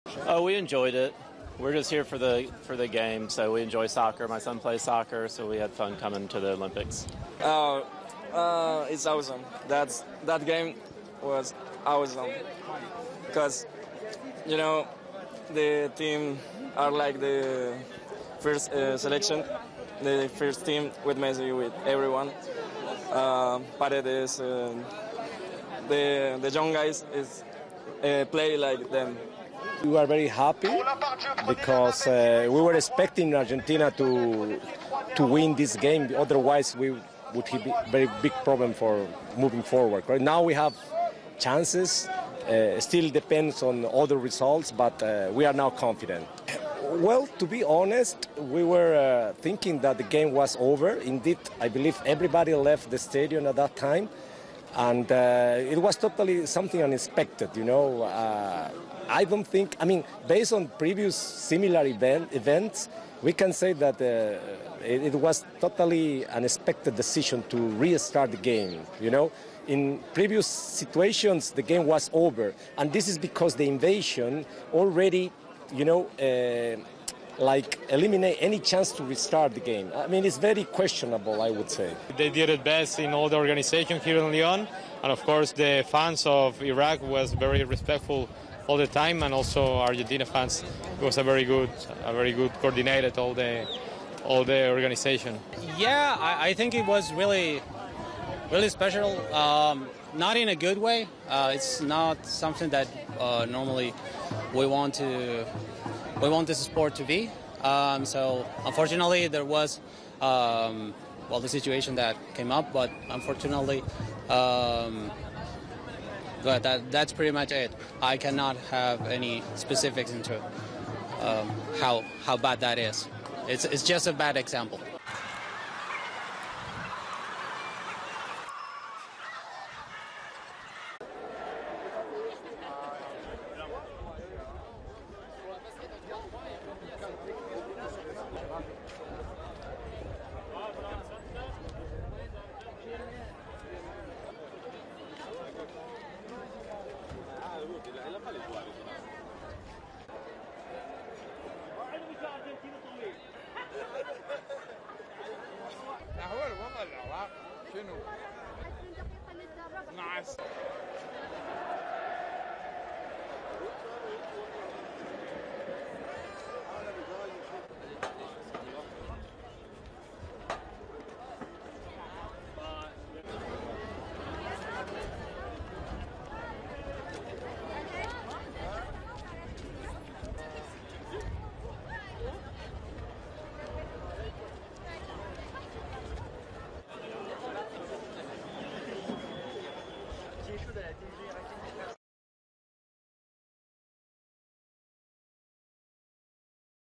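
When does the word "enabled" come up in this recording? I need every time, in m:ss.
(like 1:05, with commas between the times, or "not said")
not said.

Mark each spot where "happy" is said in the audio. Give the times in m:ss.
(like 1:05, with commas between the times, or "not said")
0:30.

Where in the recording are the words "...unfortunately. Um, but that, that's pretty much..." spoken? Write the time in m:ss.
1:53.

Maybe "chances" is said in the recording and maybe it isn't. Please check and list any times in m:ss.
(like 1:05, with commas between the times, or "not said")
0:41, 1:18.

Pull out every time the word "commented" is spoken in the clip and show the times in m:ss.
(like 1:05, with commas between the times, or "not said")
not said.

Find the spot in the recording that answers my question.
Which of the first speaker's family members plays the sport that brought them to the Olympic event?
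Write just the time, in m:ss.
0:04.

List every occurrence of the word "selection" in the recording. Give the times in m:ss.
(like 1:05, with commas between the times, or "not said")
0:18.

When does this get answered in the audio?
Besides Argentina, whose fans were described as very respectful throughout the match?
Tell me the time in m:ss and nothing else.
1:26.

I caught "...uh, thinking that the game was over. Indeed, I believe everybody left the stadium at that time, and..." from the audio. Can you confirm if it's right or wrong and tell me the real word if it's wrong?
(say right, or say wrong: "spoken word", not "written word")
right.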